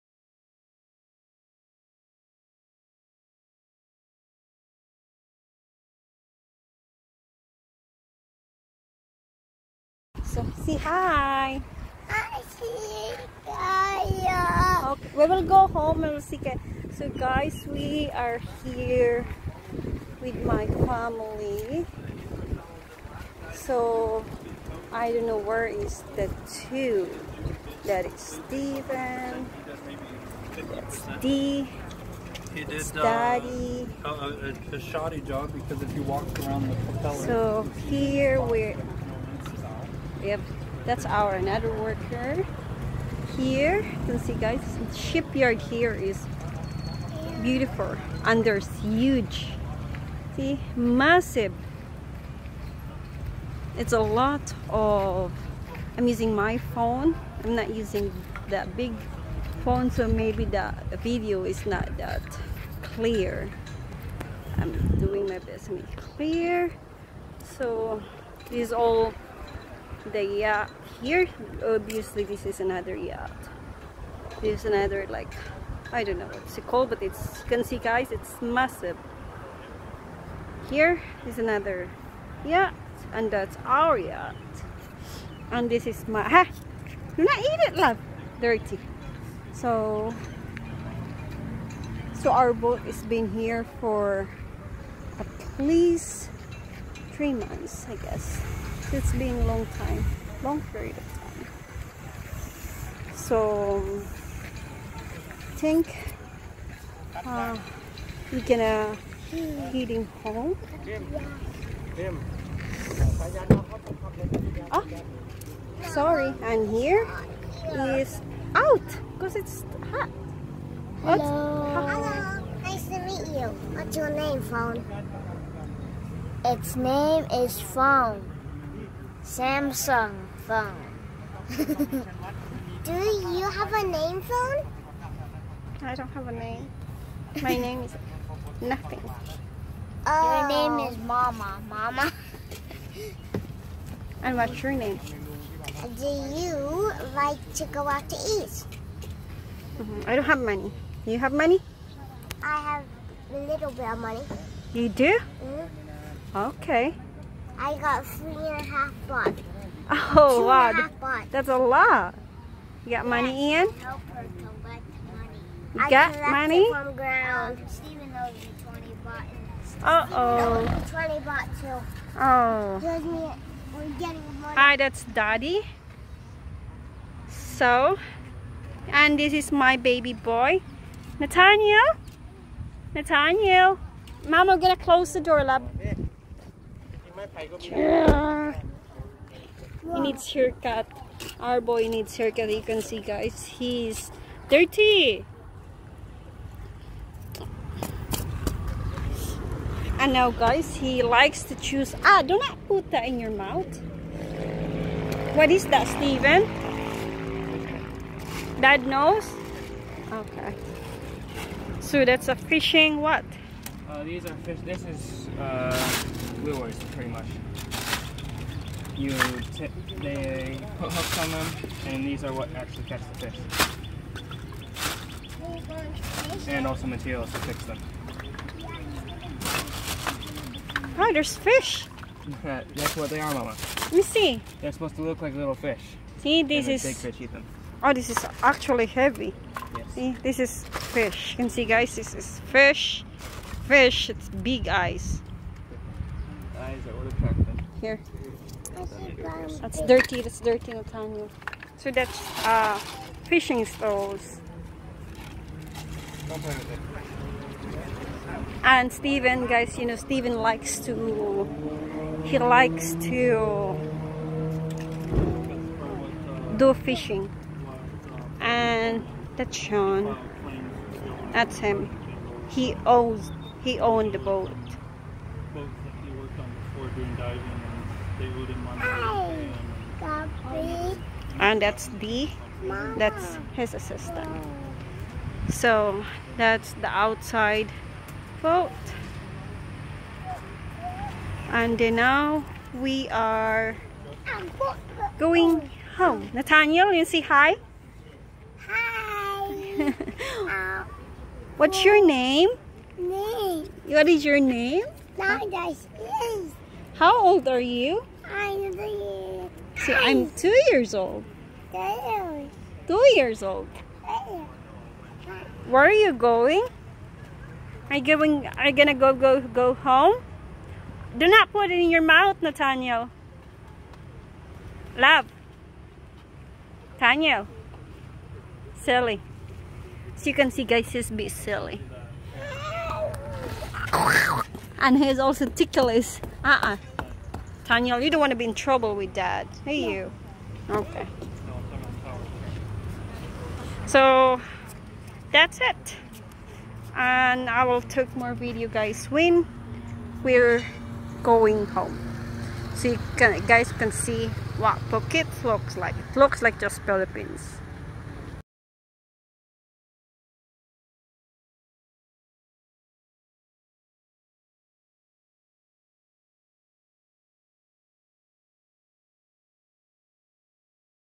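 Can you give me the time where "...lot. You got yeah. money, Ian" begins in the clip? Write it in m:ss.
2:41.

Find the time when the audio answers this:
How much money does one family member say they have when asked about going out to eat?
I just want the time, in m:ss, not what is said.
2:38.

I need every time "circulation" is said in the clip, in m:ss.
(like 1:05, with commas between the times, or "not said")
not said.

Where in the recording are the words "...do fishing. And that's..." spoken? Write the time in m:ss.
4:26.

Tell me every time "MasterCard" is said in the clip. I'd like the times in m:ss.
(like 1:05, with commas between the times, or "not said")
not said.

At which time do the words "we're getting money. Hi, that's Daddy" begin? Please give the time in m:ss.
2:52.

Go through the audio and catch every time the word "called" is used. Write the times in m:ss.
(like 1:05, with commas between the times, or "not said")
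1:16.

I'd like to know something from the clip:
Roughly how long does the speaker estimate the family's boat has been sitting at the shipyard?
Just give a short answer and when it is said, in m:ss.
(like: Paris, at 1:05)
3 months, at 1:37.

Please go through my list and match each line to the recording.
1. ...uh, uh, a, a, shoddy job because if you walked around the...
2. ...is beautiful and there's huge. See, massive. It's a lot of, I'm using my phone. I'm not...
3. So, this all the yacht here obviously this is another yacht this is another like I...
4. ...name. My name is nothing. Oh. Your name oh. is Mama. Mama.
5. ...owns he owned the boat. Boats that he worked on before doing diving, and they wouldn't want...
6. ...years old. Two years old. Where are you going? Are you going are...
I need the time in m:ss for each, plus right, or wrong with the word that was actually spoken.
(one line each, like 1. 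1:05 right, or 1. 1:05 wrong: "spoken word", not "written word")
1. 0:34 right
2. 0:45 right
3. 1:07 right
4. 2:16 right
5. 4:32 right
6. 5:10 right.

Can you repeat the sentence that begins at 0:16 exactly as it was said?
So guys, we are here with my family.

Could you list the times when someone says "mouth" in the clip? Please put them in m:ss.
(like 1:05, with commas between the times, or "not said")
3:23, 5:22.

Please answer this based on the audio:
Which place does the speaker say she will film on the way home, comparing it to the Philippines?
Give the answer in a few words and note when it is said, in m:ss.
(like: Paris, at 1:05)
Phuket, at 5:54.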